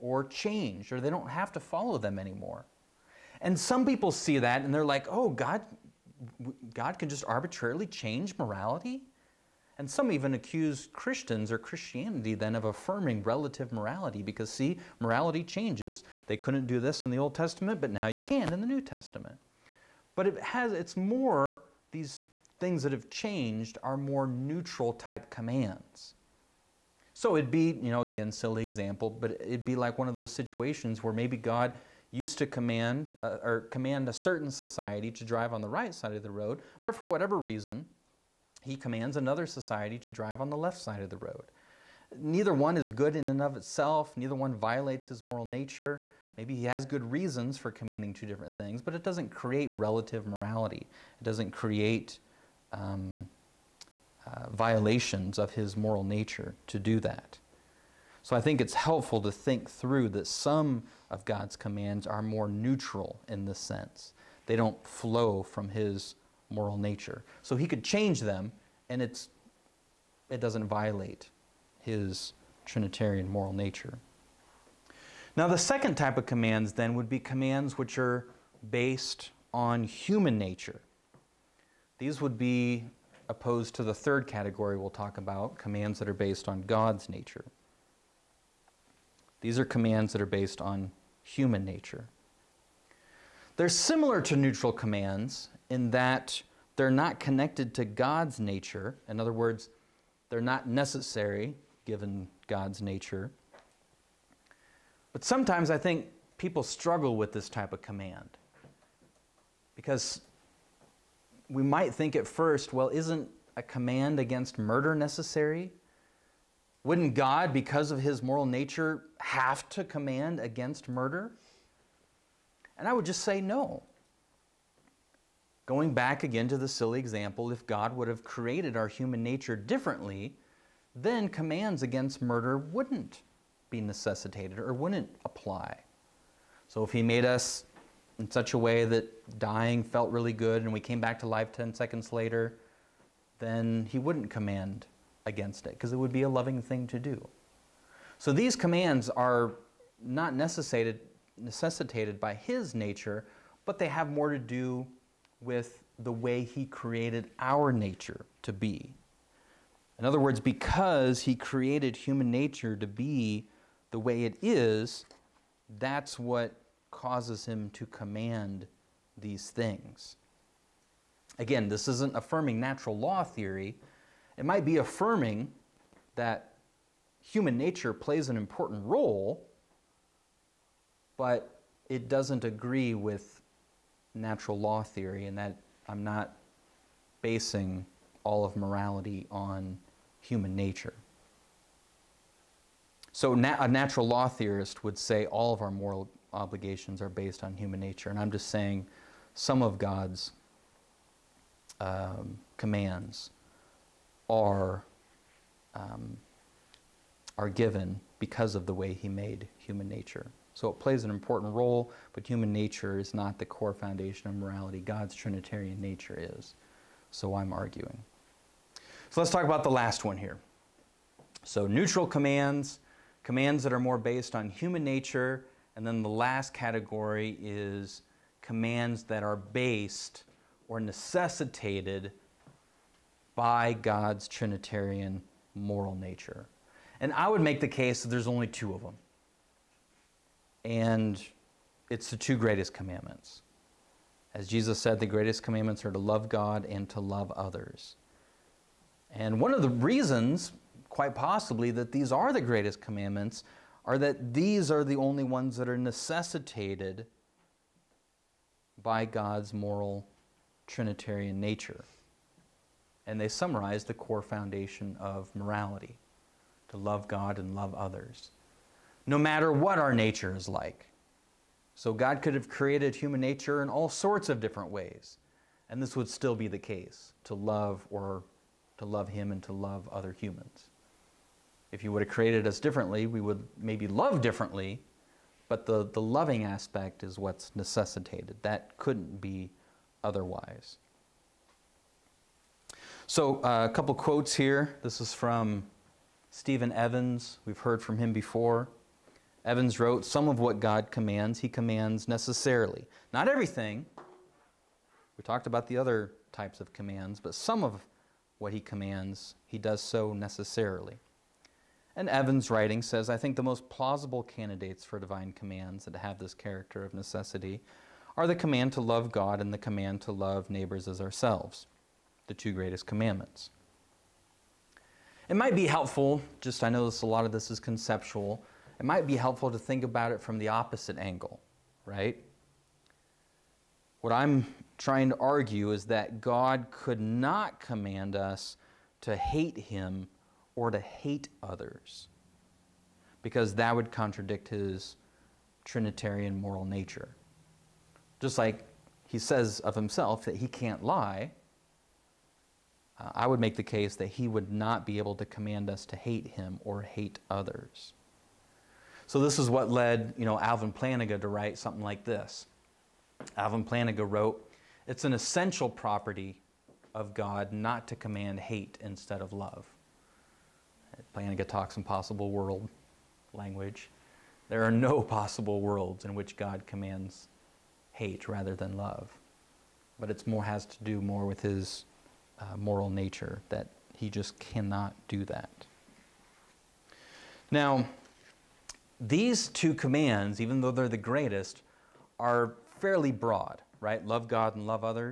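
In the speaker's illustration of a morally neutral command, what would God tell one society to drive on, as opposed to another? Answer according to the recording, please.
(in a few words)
right side of the road.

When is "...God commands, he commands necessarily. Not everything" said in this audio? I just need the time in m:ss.
5:00.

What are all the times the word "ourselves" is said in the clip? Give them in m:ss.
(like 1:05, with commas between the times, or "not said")
5:20.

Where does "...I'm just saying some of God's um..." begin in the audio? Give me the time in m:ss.
3:18.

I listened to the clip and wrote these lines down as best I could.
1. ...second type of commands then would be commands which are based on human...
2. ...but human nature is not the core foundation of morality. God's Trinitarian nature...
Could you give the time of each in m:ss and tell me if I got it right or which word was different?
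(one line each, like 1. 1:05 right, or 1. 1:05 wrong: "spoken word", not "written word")
1. 1:15 right
2. 3:32 right.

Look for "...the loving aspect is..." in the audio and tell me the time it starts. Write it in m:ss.
4:45.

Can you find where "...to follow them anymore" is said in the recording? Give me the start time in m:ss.
0:01.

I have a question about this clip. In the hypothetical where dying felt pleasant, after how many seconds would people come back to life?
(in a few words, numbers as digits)
10 seconds.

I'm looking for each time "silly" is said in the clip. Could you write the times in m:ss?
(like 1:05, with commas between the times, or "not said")
0:28, 2:06.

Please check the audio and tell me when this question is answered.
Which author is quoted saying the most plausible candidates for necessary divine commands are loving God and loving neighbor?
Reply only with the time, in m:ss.
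4:56.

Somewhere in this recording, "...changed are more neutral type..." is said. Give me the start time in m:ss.
0:23.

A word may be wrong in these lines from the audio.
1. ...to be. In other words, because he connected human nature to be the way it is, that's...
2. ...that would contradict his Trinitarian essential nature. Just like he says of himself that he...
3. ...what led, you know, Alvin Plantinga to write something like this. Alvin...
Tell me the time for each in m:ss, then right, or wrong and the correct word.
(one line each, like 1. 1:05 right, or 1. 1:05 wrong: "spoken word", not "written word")
1. 2:38 wrong: "created", not "connected"
2. 5:43 wrong: "moral", not "essential"
3. 5:59 right.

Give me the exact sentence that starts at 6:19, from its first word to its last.
But it's more has to do more with his uh, moral nature that he just cannot do that.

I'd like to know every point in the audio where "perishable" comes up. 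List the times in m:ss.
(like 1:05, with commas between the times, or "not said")
not said.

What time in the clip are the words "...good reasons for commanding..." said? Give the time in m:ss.
0:46.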